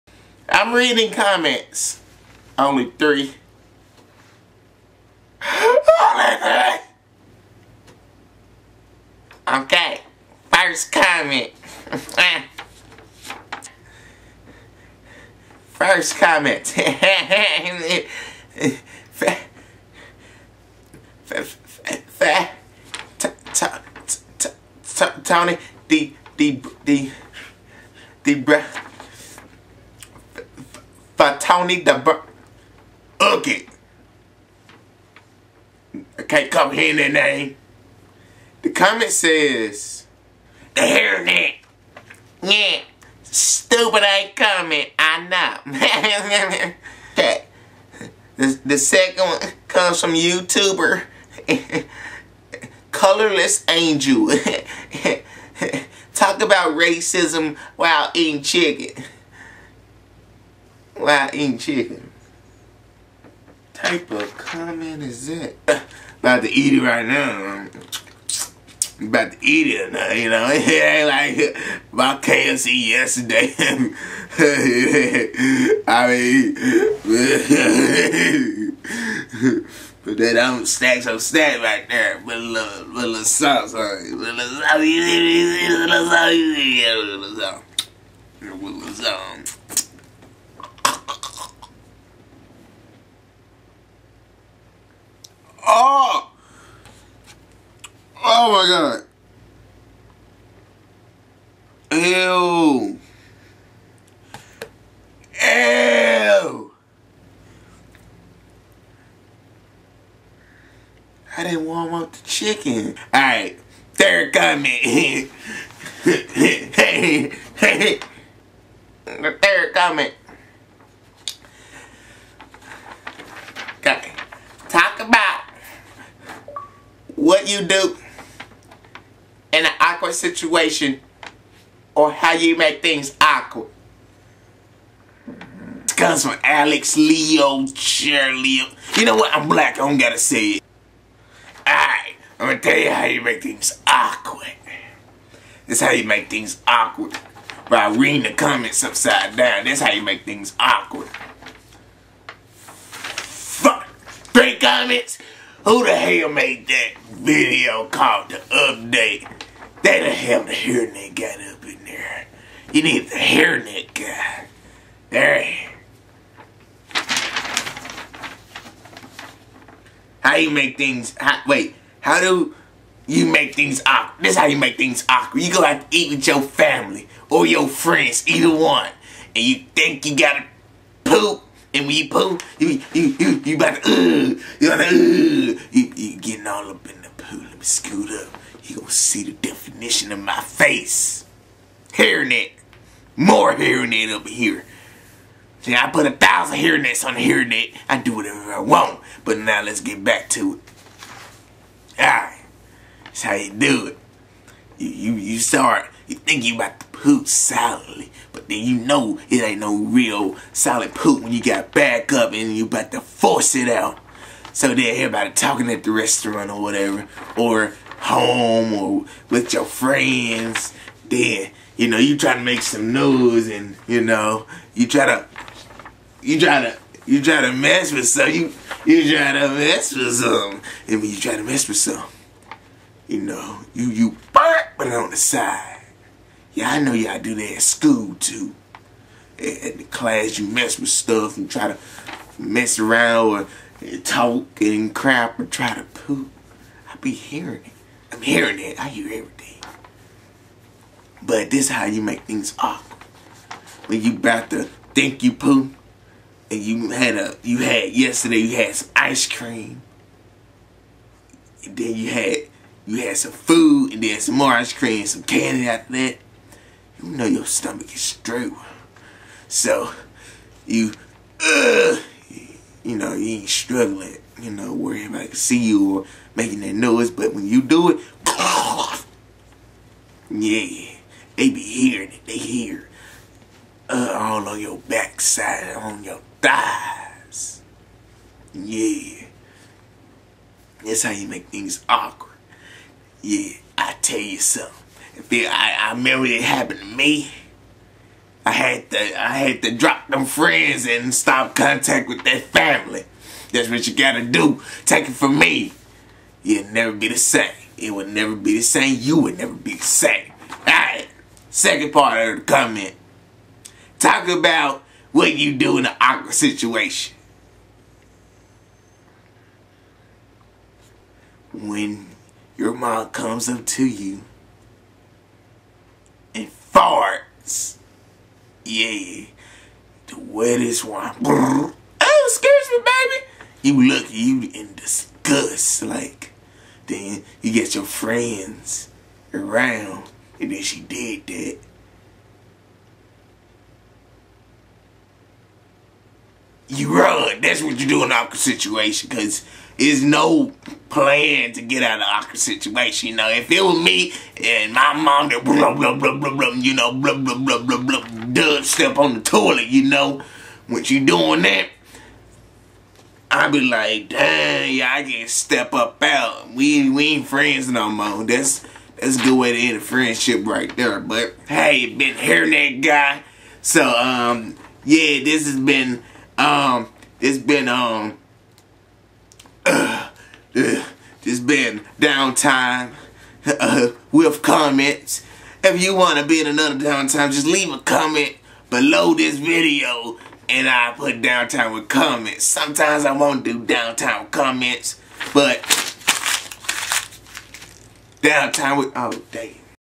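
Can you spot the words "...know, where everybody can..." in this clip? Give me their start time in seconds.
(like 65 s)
274 s.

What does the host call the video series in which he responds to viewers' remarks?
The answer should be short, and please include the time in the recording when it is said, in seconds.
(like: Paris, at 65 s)
Downtime with comments, at 381 s.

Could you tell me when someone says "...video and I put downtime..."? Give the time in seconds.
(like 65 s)
389 s.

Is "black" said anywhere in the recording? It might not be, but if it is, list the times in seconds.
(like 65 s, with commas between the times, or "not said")
139 s.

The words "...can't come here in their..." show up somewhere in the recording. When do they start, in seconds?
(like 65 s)
36 s.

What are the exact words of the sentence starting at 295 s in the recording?
If it, I, I remember it happened to me.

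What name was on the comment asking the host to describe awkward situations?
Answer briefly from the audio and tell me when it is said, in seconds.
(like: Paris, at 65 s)
Alex Leo, Charlie, at 136 s.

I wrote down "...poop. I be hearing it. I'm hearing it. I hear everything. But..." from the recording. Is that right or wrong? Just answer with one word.
right.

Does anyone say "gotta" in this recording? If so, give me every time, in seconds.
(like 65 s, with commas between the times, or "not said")
139 s, 180 s, 303 s.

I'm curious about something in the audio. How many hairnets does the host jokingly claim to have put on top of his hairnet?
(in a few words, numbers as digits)
1000.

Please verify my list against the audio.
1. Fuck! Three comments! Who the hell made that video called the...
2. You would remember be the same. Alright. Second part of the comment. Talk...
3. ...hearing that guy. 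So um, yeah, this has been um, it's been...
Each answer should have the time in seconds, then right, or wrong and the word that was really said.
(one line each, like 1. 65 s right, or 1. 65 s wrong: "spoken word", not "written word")
1. 152 s right
2. 308 s wrong: "never", not "remember"
3. 372 s right.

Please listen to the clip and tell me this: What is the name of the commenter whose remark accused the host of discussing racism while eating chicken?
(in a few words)
Colorless Angel.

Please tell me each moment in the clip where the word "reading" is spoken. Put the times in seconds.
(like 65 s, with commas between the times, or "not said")
0 s, 147 s.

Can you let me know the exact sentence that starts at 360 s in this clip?
When you doing that, I be like, dang, yeah, I can step up out.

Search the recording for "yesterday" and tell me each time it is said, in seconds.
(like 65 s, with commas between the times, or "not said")
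72 s, 257 s.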